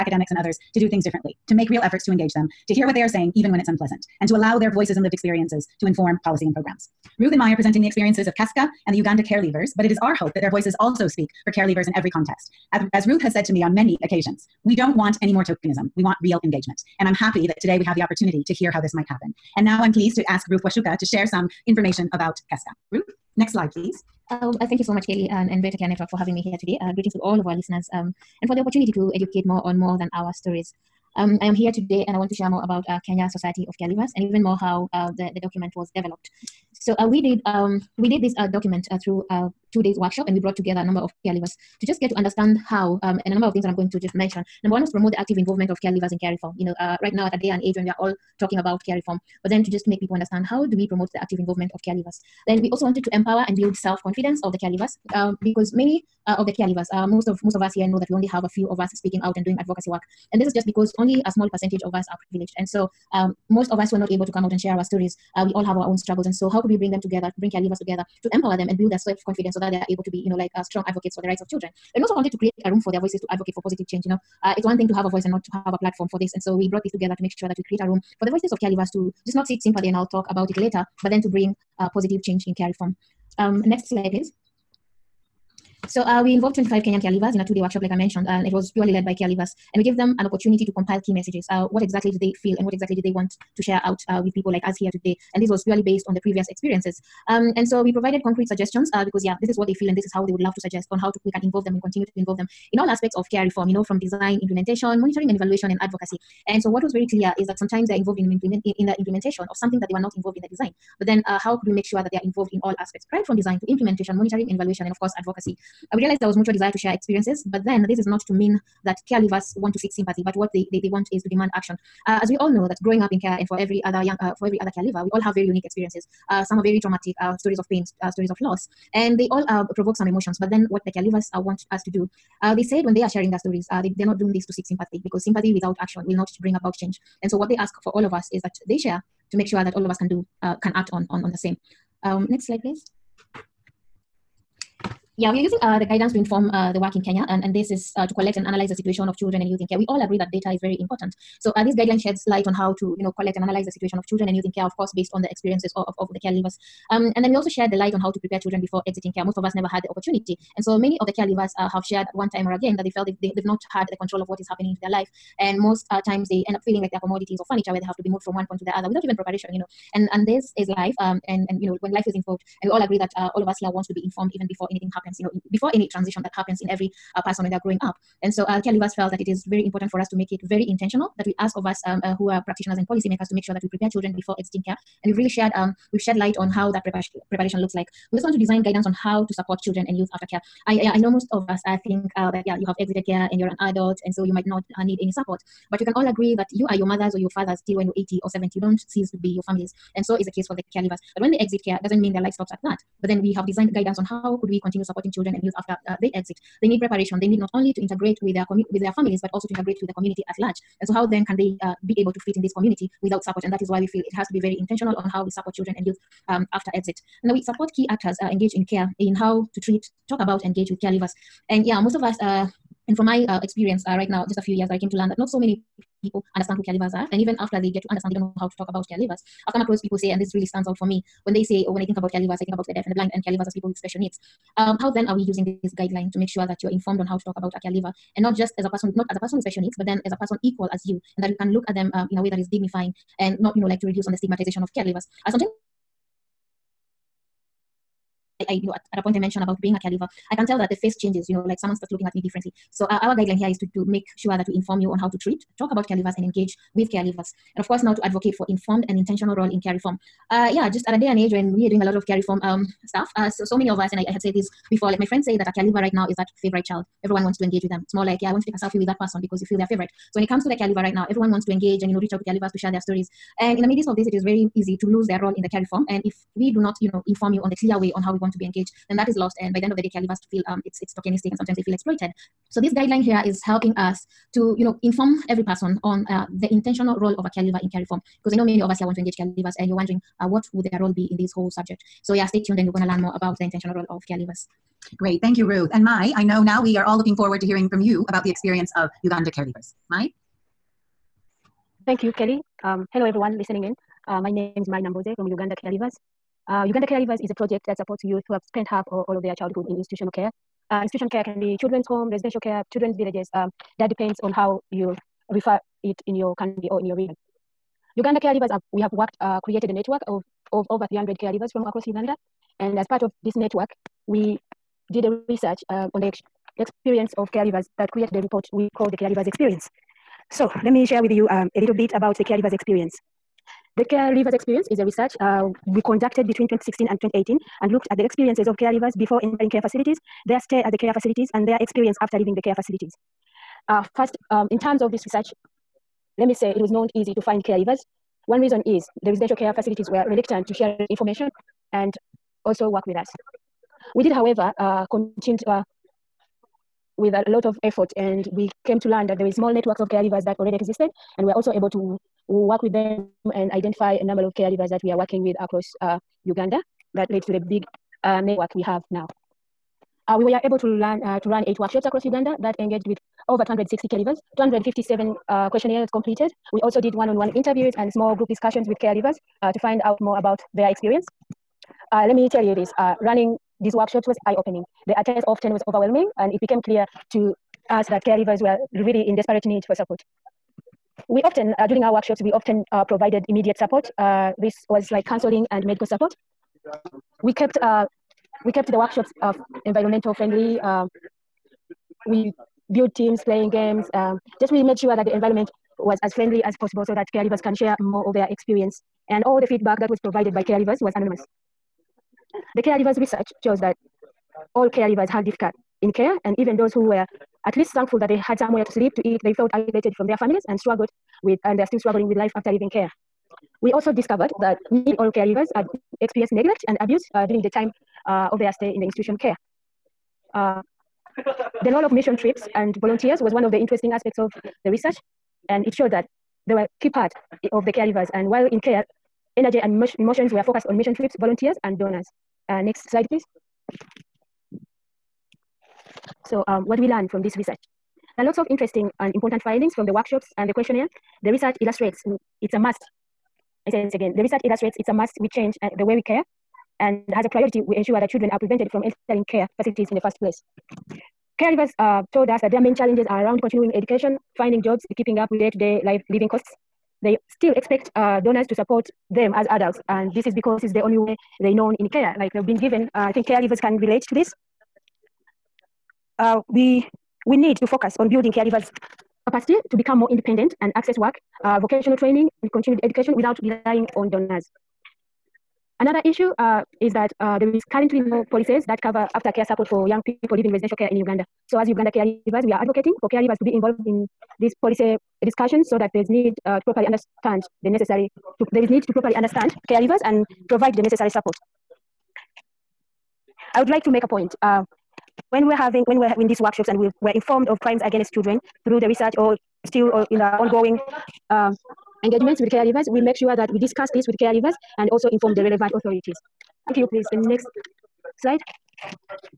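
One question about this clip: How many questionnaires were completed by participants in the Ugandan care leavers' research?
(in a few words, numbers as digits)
257.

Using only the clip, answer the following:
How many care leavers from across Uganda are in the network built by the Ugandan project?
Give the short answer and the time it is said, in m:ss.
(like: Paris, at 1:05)
Over 300, at 5:20.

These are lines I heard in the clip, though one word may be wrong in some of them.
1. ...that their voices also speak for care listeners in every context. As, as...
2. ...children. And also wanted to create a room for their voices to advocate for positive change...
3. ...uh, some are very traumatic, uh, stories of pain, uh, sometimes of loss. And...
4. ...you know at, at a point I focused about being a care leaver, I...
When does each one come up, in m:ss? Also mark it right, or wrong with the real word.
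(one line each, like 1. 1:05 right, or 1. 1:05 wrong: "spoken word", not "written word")
1. 0:10 wrong: "leavers", not "listeners"
2. 1:11 right
3. 2:06 wrong: "stories", not "sometimes"
4. 4:08 wrong: "mentioned", not "focused".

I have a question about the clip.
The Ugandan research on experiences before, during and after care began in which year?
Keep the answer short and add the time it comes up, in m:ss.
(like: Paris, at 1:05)
2016, at 5:36.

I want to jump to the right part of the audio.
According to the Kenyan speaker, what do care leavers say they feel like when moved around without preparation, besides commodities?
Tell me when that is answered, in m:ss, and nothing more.
2:47.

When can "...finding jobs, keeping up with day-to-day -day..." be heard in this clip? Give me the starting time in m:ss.
7:44.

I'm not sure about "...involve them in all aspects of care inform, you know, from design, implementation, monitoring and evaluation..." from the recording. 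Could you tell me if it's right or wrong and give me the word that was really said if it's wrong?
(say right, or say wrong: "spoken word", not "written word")
wrong: "reform", not "inform".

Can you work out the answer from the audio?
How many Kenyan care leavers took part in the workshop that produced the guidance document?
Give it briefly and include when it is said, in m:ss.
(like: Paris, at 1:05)
25, at 1:26.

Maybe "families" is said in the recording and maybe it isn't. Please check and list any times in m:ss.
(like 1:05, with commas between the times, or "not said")
3:19, 3:28, 7:00.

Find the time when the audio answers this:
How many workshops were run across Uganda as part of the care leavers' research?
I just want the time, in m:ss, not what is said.
6:11.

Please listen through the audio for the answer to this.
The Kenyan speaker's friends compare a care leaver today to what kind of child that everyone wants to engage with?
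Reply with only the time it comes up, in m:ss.
4:26.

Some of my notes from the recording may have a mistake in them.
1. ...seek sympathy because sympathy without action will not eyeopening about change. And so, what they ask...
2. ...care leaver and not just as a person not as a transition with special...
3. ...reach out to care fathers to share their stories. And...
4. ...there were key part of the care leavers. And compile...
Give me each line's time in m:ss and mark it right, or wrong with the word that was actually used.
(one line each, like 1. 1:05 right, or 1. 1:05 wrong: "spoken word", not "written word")
1. 2:14 wrong: "bring", not "eyeopening"
2. 3:57 wrong: "person", not "transition"
3. 4:31 wrong: "leavers", not "fathers"
4. 7:16 wrong: "while", not "compile".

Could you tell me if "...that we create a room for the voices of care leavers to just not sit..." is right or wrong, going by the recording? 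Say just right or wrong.
right.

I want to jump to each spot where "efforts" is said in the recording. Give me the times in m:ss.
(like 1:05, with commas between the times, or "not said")
0:01, 5:57.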